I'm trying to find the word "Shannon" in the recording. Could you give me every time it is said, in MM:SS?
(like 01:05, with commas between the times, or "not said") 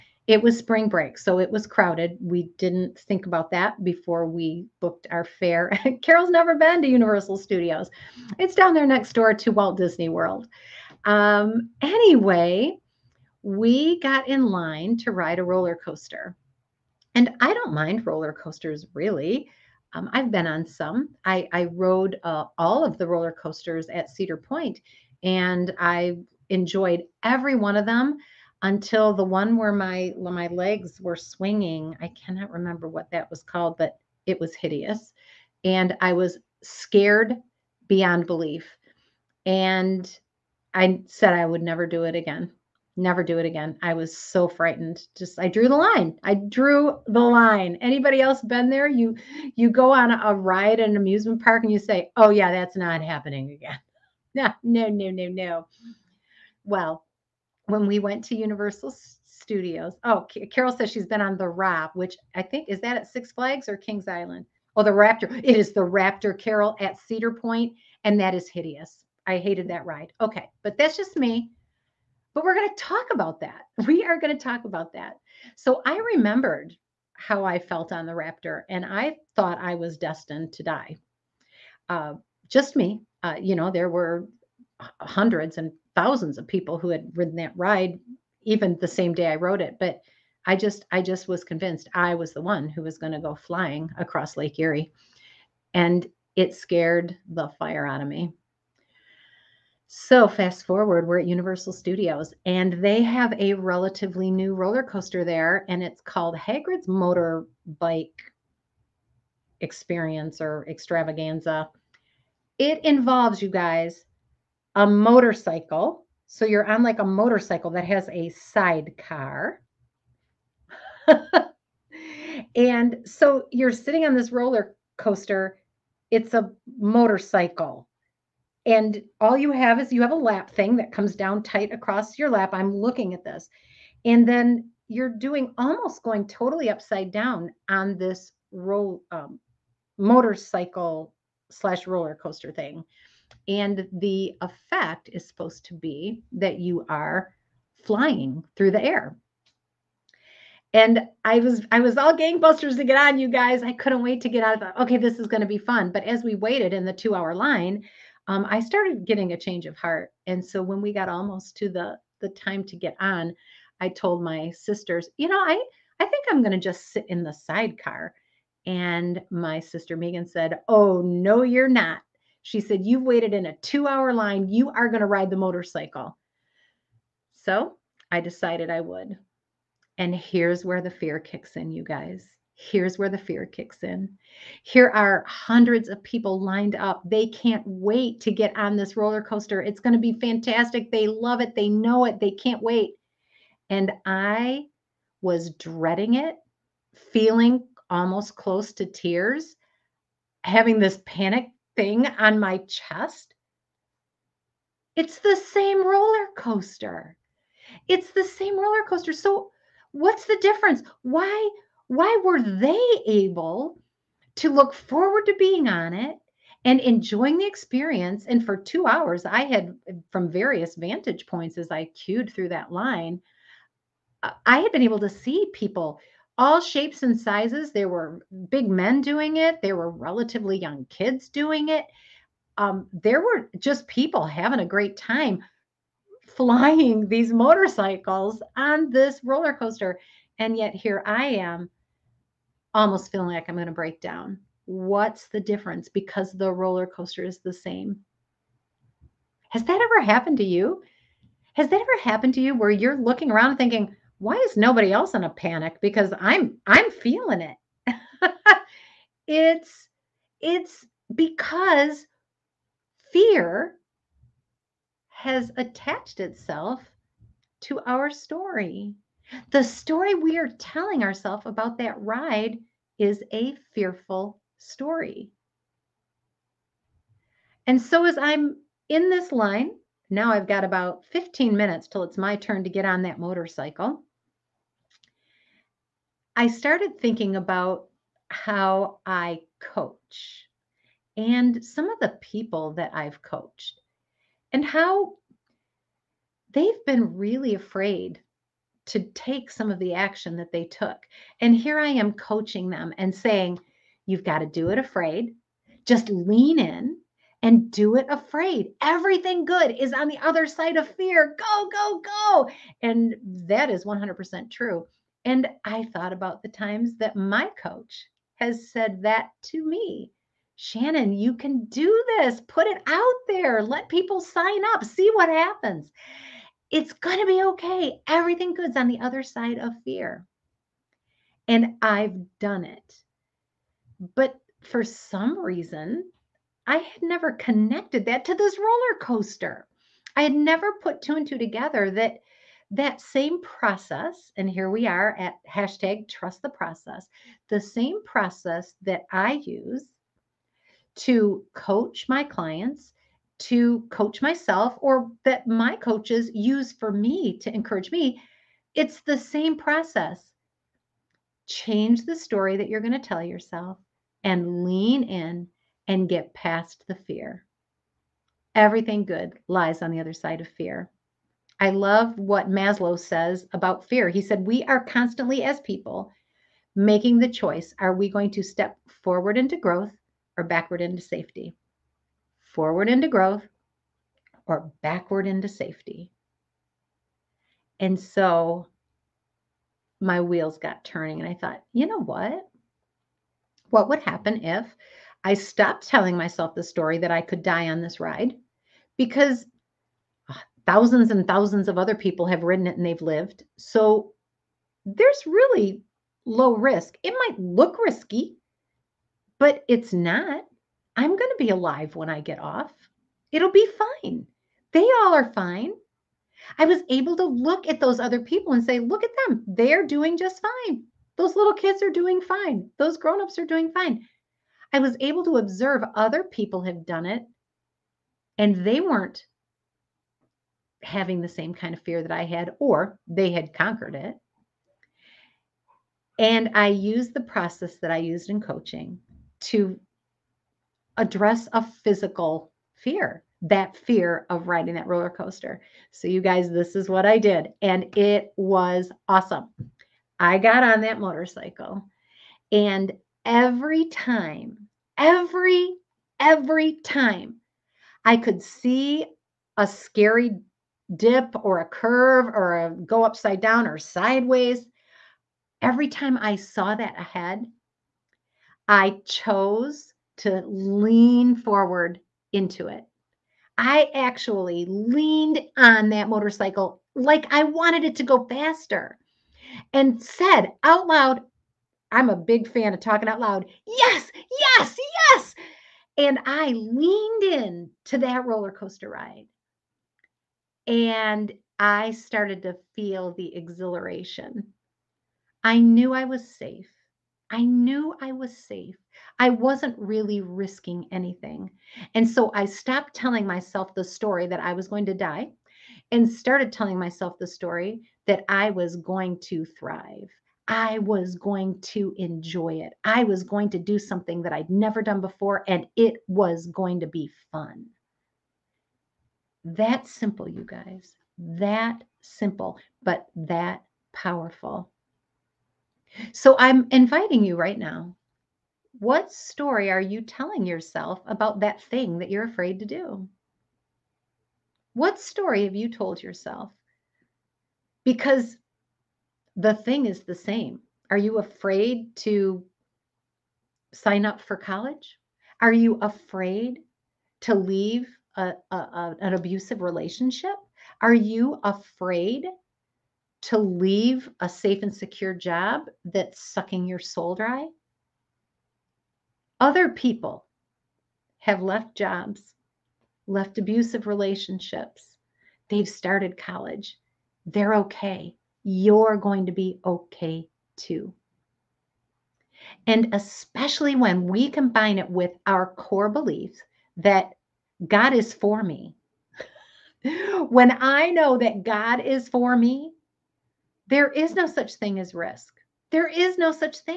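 05:20.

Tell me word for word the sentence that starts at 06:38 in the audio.
Because uh, thousands and thousands of other people have ridden it and they've lived.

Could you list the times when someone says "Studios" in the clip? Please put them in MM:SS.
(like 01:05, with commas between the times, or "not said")
00:07, 00:59, 01:41.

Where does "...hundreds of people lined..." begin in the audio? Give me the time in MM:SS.
03:05.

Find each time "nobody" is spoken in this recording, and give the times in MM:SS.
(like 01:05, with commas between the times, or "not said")
04:14.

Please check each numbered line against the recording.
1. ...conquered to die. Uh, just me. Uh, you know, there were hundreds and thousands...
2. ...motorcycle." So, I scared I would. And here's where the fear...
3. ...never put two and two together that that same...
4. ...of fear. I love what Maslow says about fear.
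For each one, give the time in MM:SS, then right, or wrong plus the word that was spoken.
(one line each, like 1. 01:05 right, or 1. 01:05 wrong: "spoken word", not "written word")
1. 01:19 wrong: "destined", not "conquered"
2. 02:55 wrong: "decided", not "scared"
3. 05:40 right
4. 06:10 right.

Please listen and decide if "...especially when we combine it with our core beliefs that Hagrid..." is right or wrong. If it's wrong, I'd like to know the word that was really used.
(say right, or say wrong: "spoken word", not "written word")
wrong: "God", not "Hagrid".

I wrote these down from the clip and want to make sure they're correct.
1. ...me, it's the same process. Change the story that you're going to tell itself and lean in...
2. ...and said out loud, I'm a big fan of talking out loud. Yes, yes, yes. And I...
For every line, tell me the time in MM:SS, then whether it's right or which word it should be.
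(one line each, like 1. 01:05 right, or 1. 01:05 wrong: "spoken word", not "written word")
1. 05:57 wrong: "yourself", not "itself"
2. 07:59 right.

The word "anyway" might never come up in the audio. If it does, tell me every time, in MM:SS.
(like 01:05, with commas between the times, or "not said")
00:11.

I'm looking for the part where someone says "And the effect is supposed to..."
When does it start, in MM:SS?
02:23.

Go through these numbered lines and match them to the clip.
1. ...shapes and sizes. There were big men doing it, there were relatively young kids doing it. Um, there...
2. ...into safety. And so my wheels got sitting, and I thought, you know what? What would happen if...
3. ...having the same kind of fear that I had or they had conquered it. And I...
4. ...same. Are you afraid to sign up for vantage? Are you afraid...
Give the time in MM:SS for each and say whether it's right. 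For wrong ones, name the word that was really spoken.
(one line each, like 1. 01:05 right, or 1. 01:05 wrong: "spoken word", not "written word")
1. 03:46 right
2. 06:25 wrong: "turning", not "sitting"
3. 07:10 right
4. 09:00 wrong: "college", not "vantage".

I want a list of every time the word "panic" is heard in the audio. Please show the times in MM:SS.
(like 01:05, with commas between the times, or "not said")
03:21, 04:15.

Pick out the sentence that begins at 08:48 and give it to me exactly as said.
What story are you telling yourself about that thing that you're afraid to do?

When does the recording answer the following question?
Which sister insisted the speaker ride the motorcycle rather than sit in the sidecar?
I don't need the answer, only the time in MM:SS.
02:49.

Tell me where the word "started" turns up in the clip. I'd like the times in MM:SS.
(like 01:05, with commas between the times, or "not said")
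02:38, 04:46, 08:11, 08:26, 09:25.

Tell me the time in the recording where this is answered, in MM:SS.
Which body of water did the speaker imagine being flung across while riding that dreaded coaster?
01:34.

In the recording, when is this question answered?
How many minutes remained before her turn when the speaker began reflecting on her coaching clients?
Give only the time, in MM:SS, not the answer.
04:41.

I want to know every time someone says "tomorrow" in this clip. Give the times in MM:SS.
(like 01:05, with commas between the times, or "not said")
not said.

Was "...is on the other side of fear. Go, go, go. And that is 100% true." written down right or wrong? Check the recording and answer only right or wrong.
right.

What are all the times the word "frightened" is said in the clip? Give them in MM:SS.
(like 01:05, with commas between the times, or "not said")
00:44.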